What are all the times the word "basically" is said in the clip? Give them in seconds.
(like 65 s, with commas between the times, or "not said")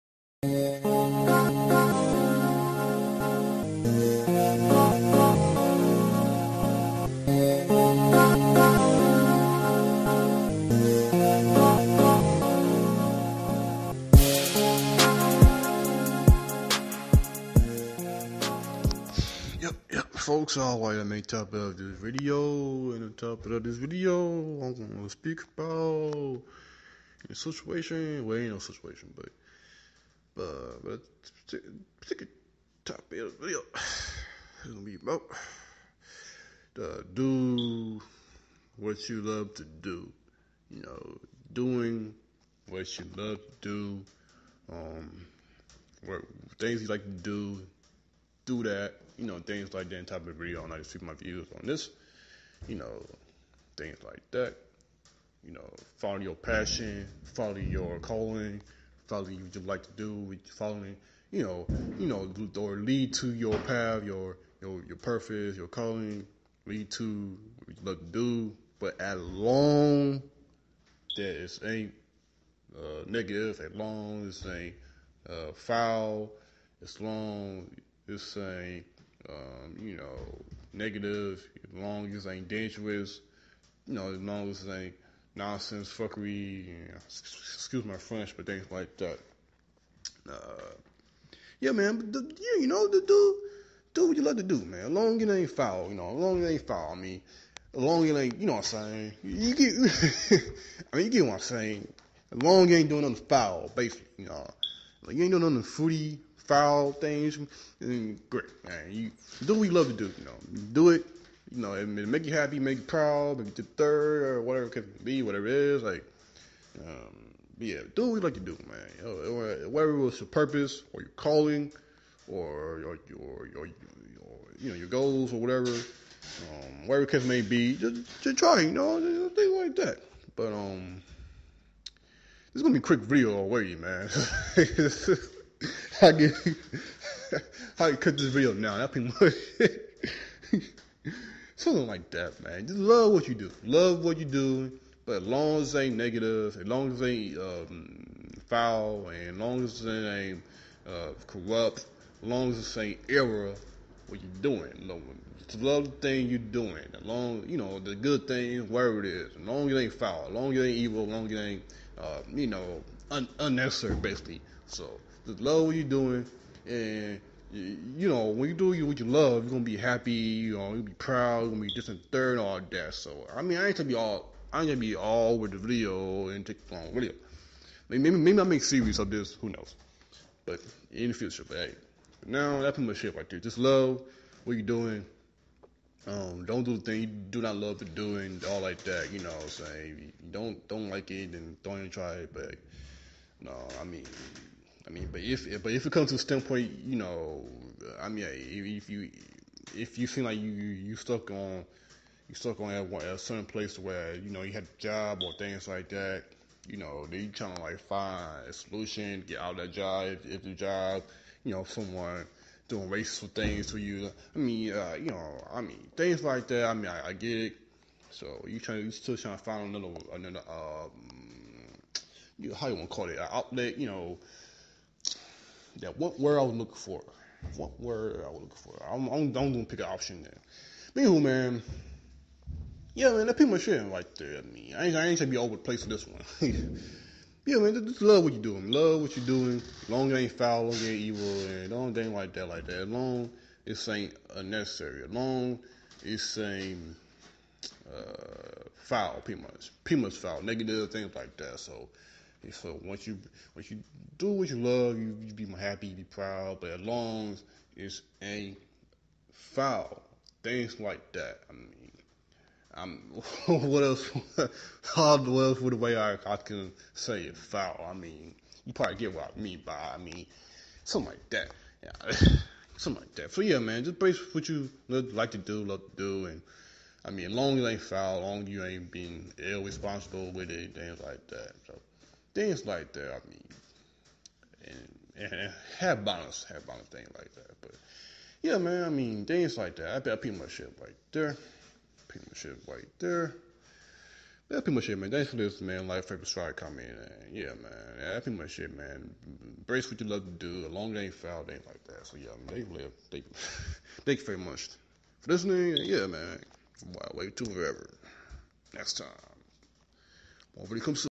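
103 s, 163 s.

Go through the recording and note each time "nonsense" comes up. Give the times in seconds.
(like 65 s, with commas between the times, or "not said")
85 s.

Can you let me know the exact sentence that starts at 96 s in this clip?
I mean, as long as it ain't, you know what I'm saying?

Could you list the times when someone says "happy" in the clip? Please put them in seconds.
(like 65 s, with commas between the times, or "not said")
112 s, 169 s, 255 s.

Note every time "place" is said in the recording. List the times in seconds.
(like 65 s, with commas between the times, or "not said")
203 s, 235 s.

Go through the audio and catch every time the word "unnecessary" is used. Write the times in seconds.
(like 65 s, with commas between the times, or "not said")
163 s, 244 s.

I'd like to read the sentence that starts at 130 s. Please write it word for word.
But um, this is gonna be a quick video already, man.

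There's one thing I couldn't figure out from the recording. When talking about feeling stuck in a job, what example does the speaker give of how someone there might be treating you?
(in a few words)
racist things.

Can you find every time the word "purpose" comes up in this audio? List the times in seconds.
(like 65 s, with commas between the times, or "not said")
64 s, 120 s.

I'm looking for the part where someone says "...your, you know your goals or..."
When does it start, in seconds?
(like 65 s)
123 s.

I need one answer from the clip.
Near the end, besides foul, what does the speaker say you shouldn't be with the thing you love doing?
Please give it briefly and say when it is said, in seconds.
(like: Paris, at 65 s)
irresponsible, at 279 s.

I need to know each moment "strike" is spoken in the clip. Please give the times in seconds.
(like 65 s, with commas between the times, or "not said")
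296 s.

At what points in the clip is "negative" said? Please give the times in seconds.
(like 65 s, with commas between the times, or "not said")
73 s, 80 s, 145 s, 250 s.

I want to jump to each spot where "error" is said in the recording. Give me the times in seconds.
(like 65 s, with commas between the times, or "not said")
153 s.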